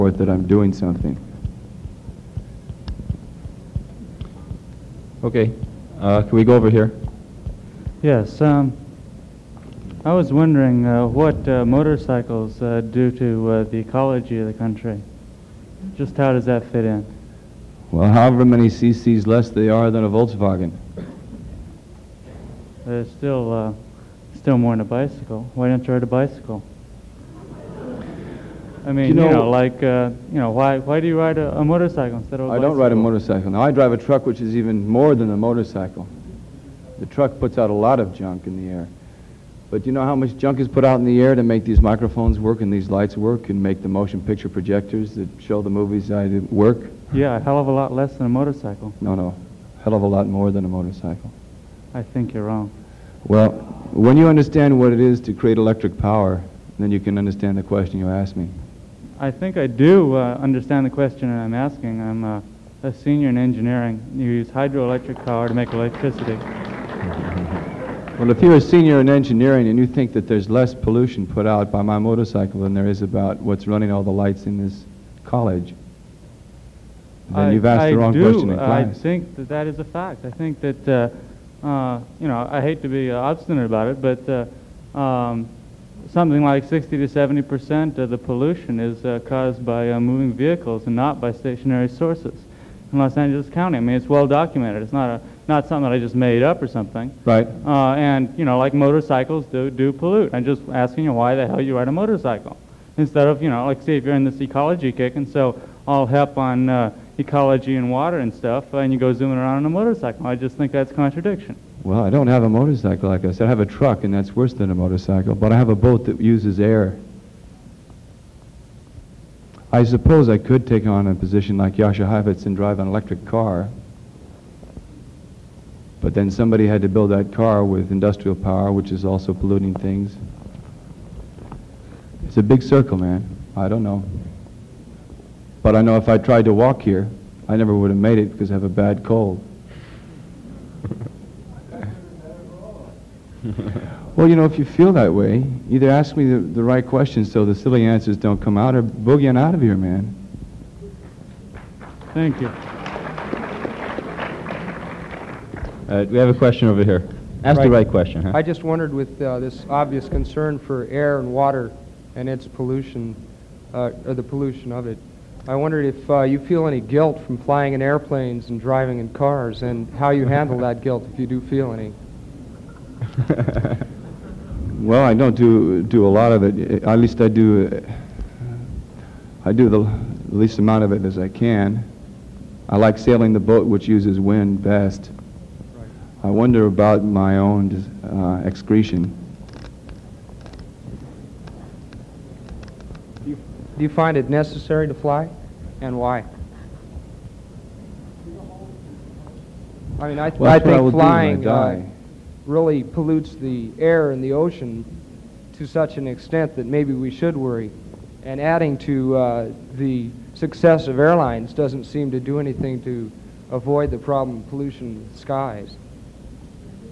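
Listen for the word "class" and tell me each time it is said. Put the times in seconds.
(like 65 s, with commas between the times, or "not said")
78 s.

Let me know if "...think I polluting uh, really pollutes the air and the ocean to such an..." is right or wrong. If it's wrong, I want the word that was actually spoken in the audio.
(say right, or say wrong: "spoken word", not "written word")
wrong: "flying", not "polluting".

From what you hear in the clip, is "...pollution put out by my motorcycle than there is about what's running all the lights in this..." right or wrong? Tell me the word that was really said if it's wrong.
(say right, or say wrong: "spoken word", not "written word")
right.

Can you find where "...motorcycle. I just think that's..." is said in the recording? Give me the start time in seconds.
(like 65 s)
109 s.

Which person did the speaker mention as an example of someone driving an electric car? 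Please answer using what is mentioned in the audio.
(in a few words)
Jascha Heifetz.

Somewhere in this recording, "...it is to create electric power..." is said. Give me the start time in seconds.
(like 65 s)
54 s.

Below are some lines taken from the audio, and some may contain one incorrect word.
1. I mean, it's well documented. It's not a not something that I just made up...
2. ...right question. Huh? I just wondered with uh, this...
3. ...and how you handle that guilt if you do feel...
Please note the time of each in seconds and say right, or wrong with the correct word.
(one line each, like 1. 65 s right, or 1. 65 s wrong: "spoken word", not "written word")
1. 93 s right
2. 157 s right
3. 169 s right.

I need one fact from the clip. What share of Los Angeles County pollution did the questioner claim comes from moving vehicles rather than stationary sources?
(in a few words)
60 to 70 percent.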